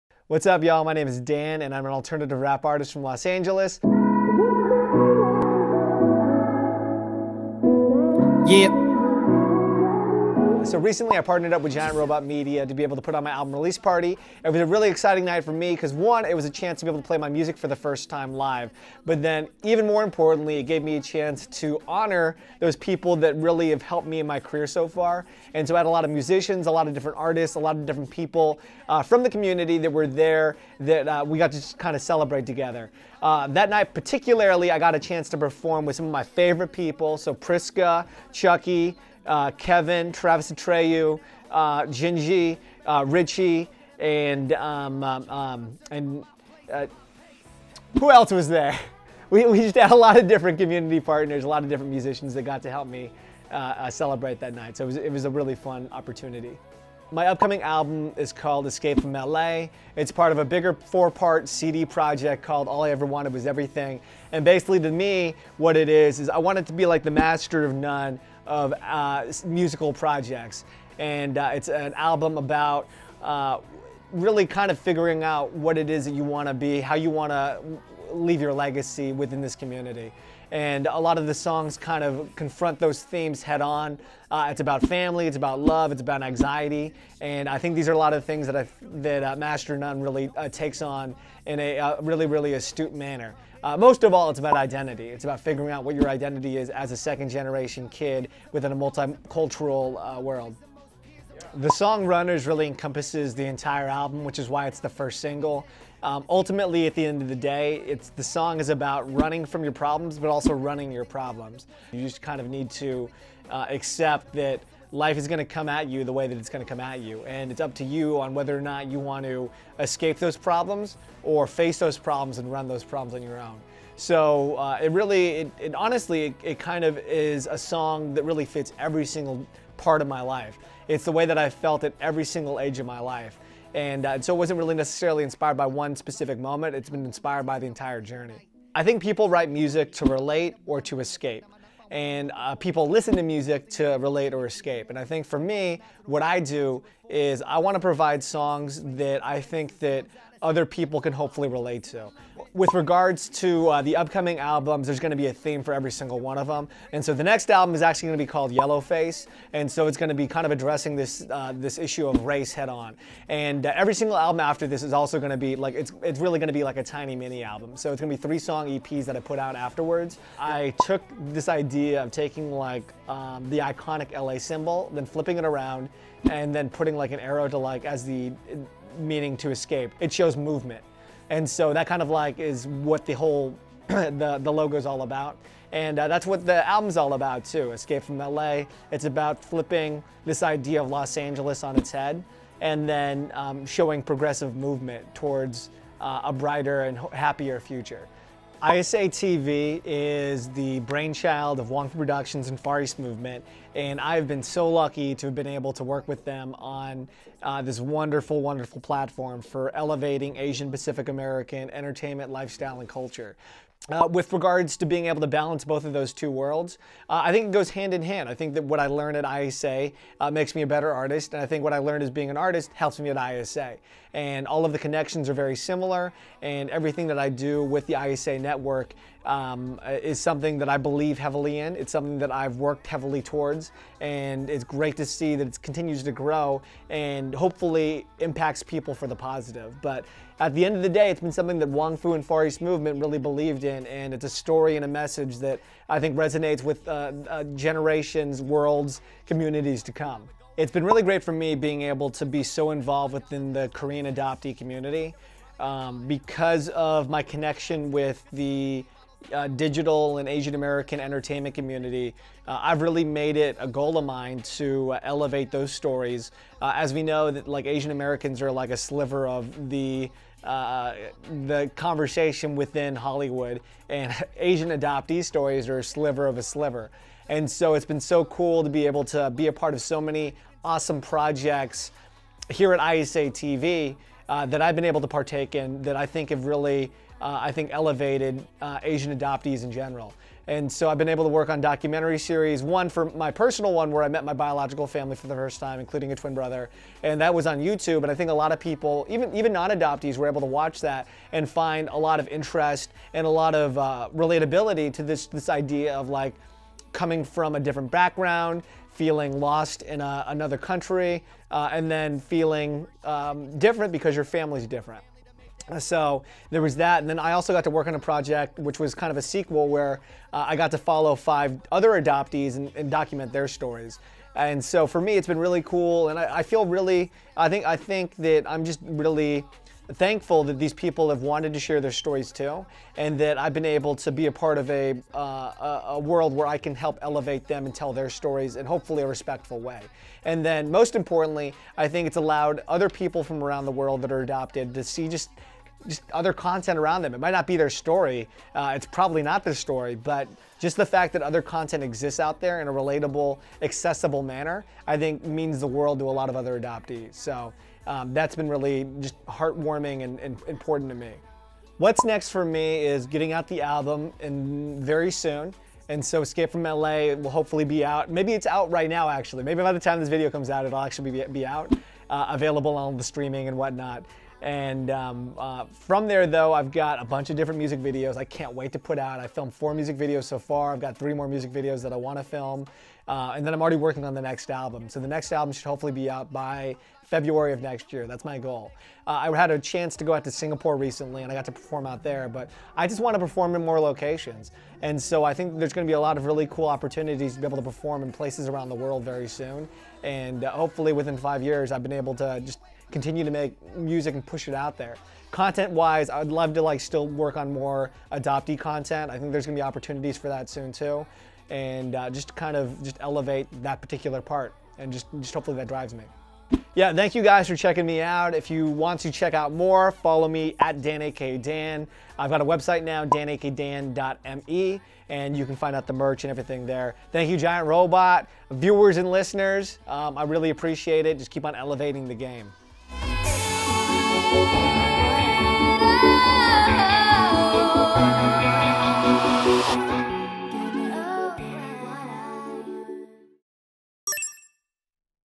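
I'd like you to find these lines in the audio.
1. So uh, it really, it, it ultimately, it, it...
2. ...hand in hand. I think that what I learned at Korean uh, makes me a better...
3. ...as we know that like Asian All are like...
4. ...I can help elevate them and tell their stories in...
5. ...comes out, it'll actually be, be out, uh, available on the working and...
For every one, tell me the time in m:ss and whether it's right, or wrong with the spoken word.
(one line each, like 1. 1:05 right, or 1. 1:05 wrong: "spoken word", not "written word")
1. 2:03 wrong: "honestly", not "ultimately"
2. 3:37 wrong: "ISA", not "Korean"
3. 4:26 wrong: "Americans", not "All"
4. 5:36 right
5. 6:10 wrong: "streaming", not "working".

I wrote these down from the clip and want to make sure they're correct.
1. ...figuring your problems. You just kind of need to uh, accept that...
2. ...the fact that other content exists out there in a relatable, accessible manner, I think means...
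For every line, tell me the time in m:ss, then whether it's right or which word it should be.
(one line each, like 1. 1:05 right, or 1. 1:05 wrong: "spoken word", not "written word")
1. 1:50 wrong: "running", not "figuring"
2. 5:50 right.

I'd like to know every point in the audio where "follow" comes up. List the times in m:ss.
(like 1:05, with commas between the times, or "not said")
5:20, 6:59.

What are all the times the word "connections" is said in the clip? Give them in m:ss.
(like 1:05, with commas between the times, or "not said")
3:44, 4:17.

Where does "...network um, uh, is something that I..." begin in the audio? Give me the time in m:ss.
3:48.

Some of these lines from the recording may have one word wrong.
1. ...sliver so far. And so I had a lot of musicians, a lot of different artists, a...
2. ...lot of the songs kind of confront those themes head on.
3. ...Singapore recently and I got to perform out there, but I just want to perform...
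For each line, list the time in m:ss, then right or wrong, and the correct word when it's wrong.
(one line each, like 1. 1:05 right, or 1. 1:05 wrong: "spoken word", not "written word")
1. 0:24 wrong: "career", not "sliver"
2. 1:20 right
3. 6:30 right.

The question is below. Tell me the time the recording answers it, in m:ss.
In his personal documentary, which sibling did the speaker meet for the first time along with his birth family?
4:56.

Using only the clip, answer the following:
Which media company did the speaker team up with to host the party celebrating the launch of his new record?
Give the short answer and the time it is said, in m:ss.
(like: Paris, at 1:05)
Giant Robot Media, at 0:11.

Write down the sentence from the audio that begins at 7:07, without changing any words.
Thank you, Giant Robot, viewers and listeners.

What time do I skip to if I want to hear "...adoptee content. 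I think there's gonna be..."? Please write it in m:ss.
6:48.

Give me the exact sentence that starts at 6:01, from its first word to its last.
What's next for me is getting out the album and very soon.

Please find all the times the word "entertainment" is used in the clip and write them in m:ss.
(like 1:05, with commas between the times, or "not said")
3:31, 4:20.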